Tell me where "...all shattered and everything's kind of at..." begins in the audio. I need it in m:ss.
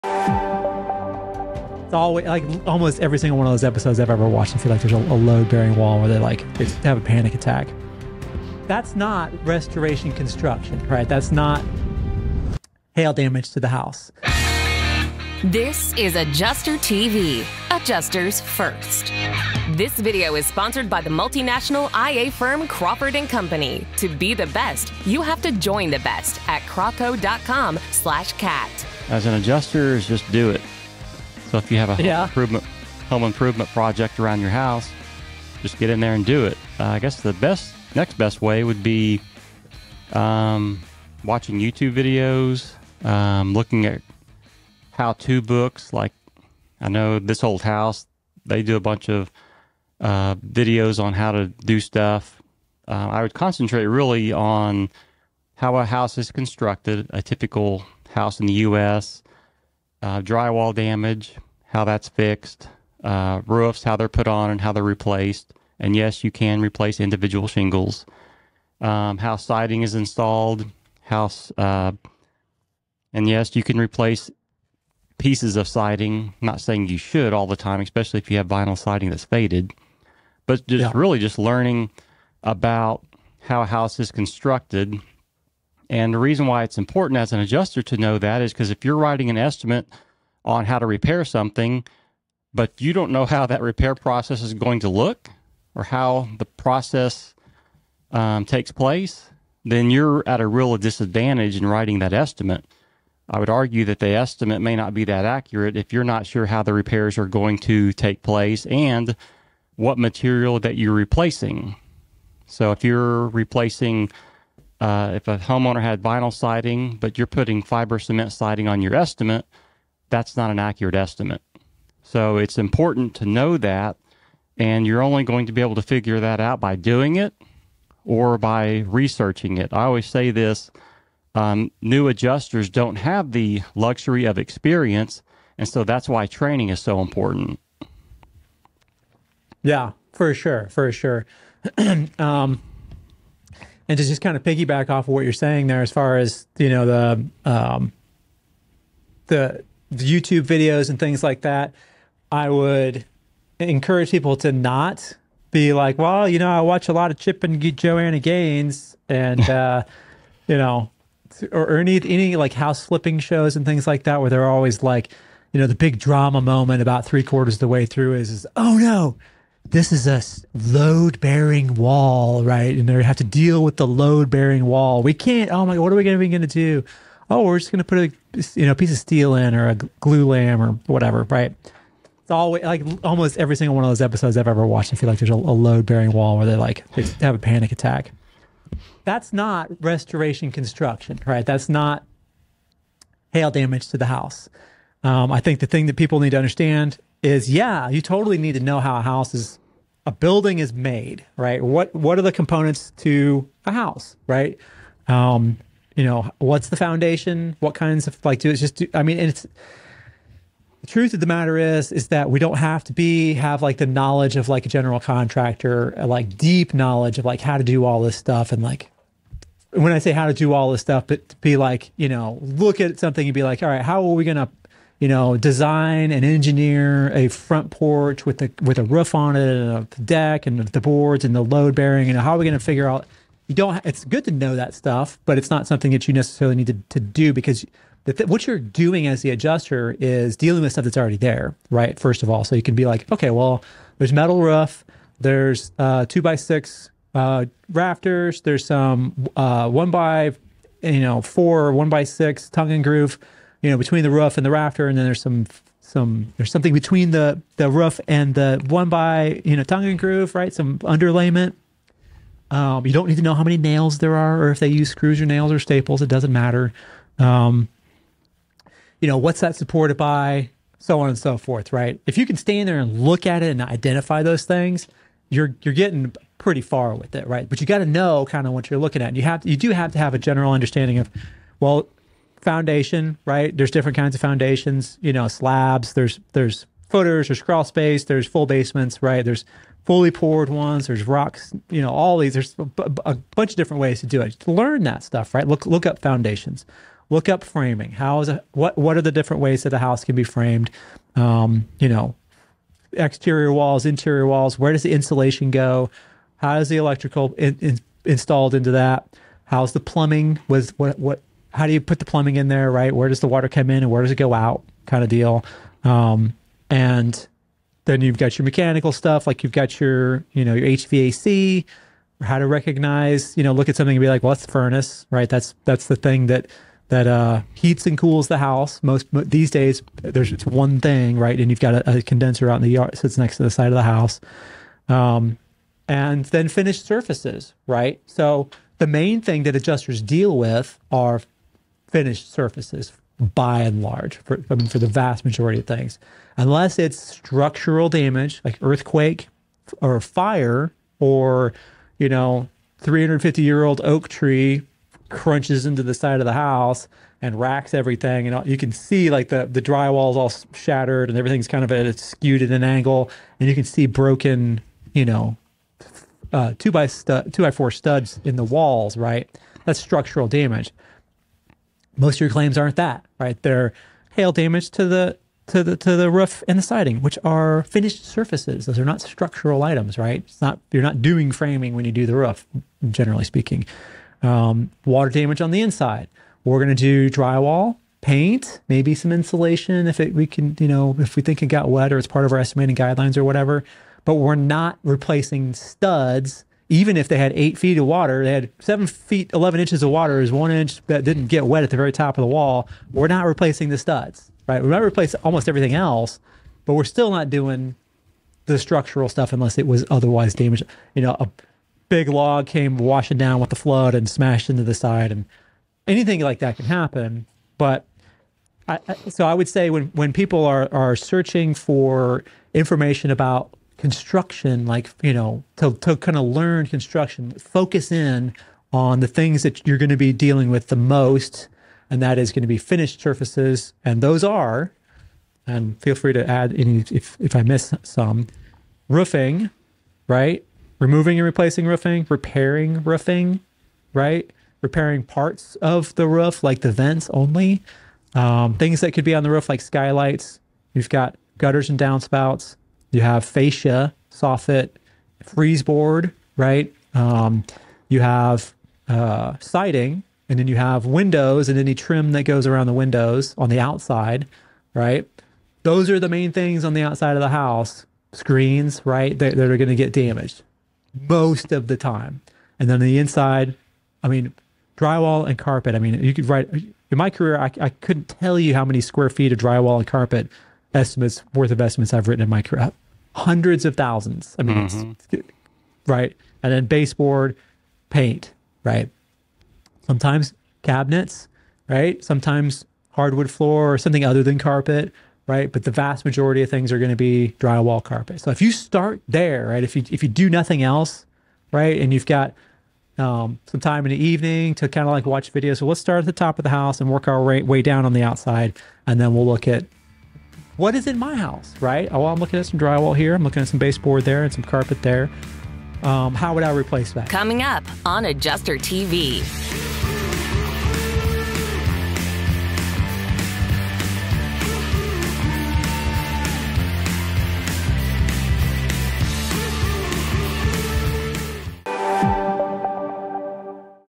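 6:00.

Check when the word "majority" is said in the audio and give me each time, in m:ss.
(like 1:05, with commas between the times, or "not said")
5:45, 8:16.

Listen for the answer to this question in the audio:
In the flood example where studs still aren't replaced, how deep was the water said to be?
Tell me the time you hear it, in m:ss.
6:38.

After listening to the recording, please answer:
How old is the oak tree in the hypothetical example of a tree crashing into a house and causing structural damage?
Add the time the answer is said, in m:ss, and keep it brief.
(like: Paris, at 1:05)
350 years, at 5:52.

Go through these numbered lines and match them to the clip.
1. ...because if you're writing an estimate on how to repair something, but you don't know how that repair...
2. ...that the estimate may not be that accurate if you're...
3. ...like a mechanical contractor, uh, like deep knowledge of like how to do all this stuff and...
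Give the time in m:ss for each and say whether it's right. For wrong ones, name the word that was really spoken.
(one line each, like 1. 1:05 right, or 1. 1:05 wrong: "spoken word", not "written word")
1. 1:28 right
2. 1:43 right
3. 3:34 wrong: "general", not "mechanical".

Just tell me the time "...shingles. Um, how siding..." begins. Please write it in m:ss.
1:07.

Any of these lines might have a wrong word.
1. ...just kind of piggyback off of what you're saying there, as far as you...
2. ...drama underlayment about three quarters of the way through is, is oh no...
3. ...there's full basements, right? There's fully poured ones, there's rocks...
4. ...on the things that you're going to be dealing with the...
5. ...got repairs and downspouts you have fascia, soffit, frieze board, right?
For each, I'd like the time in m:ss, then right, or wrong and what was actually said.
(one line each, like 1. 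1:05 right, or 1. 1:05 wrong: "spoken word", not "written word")
1. 2:24 right
2. 2:45 wrong: "moment", not "underlayment"
3. 4:48 right
4. 7:08 right
5. 7:30 wrong: "gutters", not "repairs".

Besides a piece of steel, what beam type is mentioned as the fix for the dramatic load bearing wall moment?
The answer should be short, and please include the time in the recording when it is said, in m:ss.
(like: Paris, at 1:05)
glulam, at 2:59.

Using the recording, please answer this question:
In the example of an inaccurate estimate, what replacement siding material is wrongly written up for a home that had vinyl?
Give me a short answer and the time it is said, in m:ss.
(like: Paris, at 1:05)
fiber cement siding, at 1:57.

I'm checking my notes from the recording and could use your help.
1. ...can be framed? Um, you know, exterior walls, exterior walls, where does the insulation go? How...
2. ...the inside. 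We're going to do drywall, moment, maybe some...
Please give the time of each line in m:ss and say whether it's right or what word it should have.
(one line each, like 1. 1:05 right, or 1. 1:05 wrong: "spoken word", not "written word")
1. 5:00 wrong: "interior", not "exterior"
2. 6:25 wrong: "paint", not "moment".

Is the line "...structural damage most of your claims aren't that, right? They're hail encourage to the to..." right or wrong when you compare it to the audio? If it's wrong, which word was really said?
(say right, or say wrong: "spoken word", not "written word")
wrong: "damage", not "encourage".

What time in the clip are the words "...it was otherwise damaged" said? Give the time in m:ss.
6:49.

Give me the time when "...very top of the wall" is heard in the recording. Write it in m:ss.
6:41.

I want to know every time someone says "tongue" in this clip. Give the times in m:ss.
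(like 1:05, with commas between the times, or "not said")
4:12, 4:19.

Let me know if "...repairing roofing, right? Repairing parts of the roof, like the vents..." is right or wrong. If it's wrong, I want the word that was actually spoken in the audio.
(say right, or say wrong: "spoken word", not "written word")
right.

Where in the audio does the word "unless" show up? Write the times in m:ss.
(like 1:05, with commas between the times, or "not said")
5:46, 6:49.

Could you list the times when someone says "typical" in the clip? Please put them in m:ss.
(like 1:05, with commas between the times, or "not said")
0:57.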